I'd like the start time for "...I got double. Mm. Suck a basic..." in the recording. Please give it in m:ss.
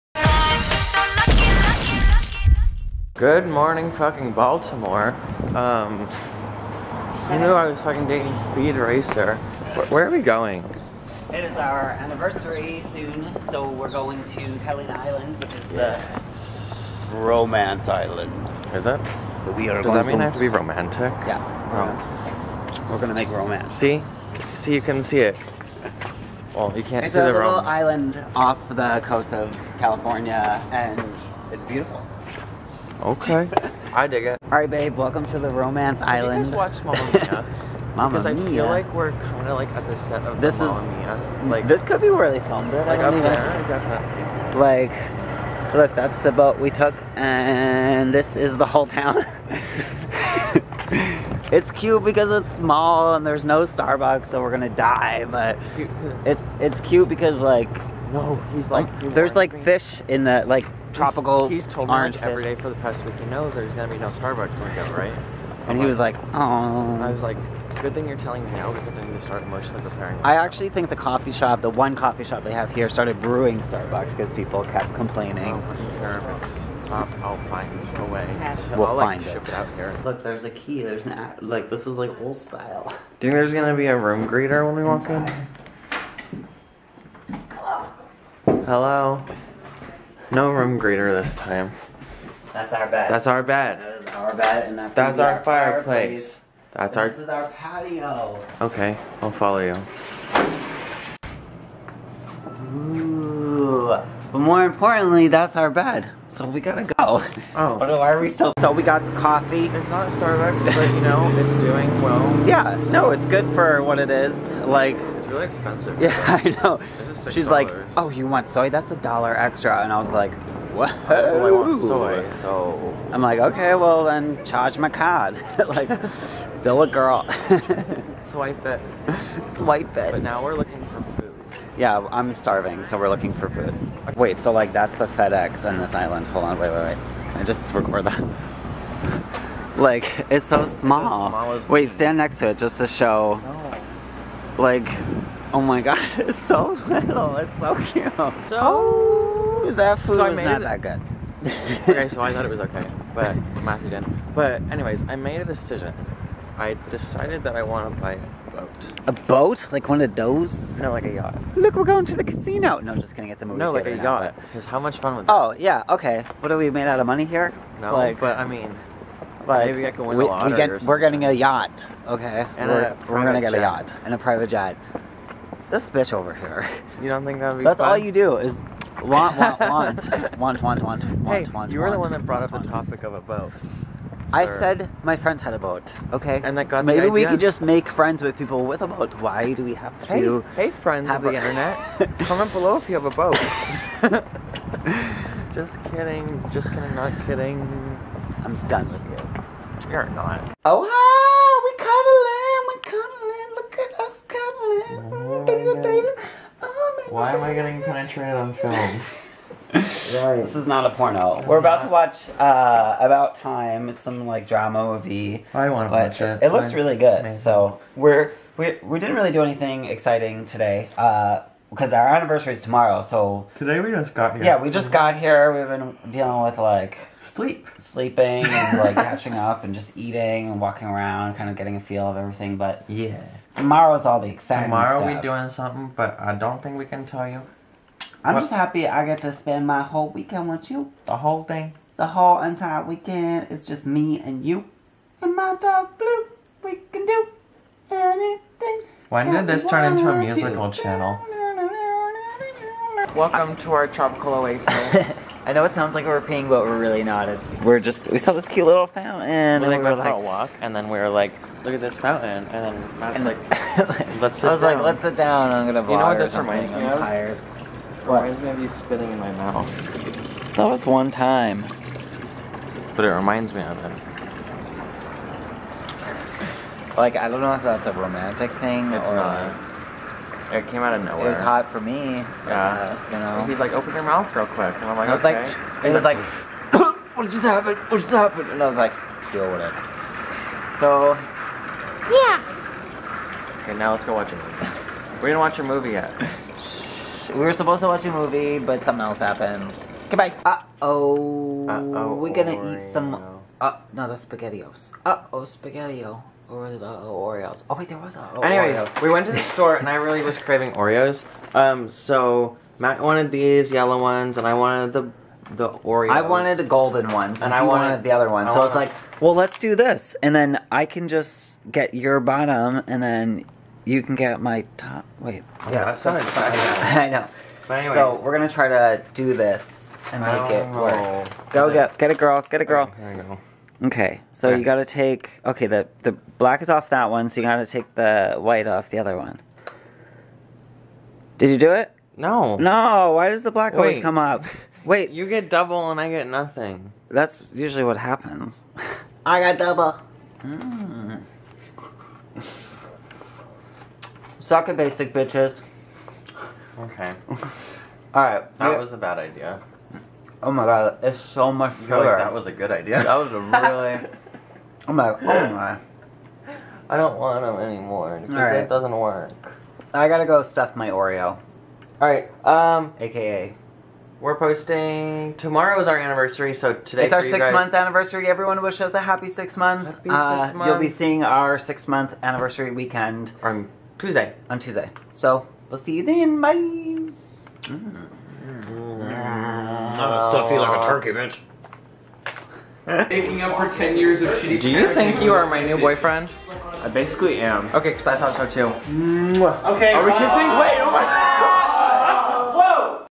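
5:49.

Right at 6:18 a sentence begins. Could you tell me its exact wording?
Everyone wish us a happy six month.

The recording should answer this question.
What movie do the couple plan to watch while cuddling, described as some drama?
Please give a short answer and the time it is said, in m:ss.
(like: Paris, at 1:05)
About Time, at 3:32.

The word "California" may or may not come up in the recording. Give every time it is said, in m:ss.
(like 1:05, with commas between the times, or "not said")
0:29.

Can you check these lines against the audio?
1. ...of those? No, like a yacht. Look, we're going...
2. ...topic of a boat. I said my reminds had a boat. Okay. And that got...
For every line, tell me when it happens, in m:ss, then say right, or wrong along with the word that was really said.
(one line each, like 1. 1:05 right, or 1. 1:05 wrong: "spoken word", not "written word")
1. 2:40 right
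2. 3:02 wrong: "friends", not "reminds".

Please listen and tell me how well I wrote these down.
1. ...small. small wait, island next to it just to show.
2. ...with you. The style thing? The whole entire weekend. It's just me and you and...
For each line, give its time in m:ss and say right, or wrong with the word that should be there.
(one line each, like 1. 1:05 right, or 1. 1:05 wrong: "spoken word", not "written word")
1. 2:20 wrong: "stand", not "island"
2. 4:00 wrong: "whole", not "style".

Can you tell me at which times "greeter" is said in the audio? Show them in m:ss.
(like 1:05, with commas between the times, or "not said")
1:24, 1:30.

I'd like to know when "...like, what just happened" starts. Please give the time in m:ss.
4:46.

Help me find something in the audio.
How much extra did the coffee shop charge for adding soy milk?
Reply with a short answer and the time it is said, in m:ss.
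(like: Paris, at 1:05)
A dollar, at 1:58.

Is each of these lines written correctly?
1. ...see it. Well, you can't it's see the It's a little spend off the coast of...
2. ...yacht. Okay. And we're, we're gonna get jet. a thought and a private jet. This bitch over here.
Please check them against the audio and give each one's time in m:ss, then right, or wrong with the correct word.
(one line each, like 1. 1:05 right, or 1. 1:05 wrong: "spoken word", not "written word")
1. 0:25 wrong: "island", not "spend"
2. 2:51 wrong: "yacht", not "thought".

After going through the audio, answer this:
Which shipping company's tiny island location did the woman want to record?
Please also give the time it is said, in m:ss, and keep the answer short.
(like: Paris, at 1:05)
FedEx, at 2:15.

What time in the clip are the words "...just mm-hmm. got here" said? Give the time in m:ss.
3:44.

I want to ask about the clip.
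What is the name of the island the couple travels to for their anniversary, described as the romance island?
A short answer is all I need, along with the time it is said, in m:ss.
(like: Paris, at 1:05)
Helen Island, at 0:14.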